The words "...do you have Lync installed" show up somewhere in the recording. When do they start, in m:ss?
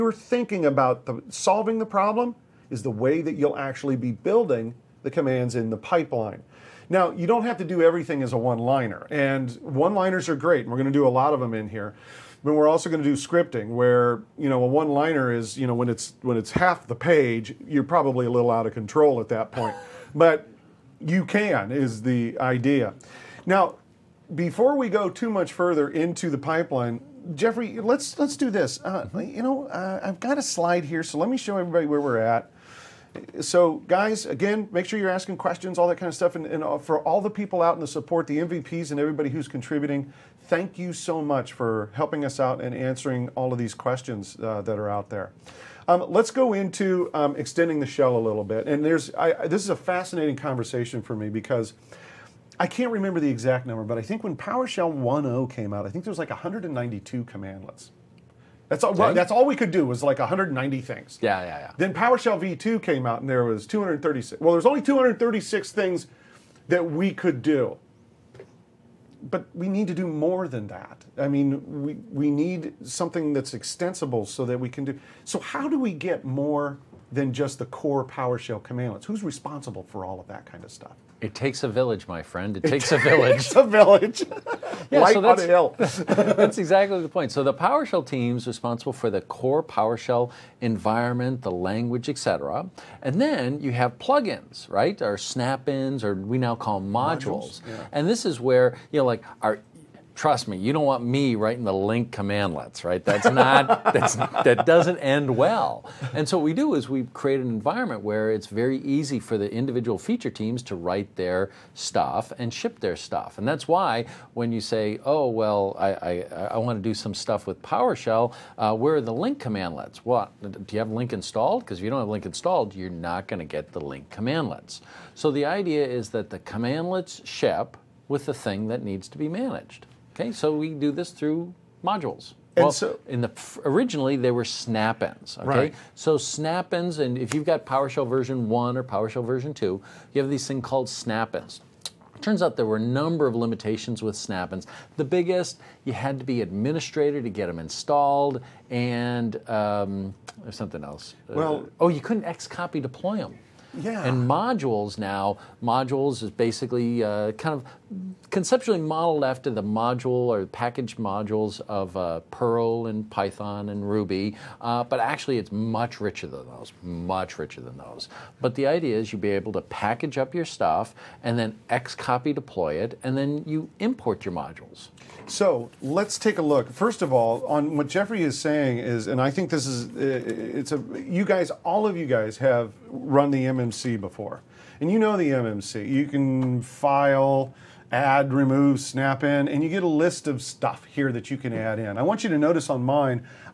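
2:00.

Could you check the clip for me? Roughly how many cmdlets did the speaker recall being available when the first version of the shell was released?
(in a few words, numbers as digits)
192.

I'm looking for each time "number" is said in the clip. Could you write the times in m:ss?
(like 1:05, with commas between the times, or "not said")
0:53, 2:22.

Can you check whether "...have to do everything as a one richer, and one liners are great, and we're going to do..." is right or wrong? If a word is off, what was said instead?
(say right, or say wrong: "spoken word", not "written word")
wrong: "liner", not "richer".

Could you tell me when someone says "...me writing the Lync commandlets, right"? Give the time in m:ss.
1:41.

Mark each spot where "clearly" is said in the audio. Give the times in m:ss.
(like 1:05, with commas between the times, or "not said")
not said.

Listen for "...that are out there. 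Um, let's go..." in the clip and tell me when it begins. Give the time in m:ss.
0:44.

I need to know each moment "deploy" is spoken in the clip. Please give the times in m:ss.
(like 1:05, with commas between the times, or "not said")
2:32, 2:52.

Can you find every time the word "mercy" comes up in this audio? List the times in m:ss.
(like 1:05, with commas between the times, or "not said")
not said.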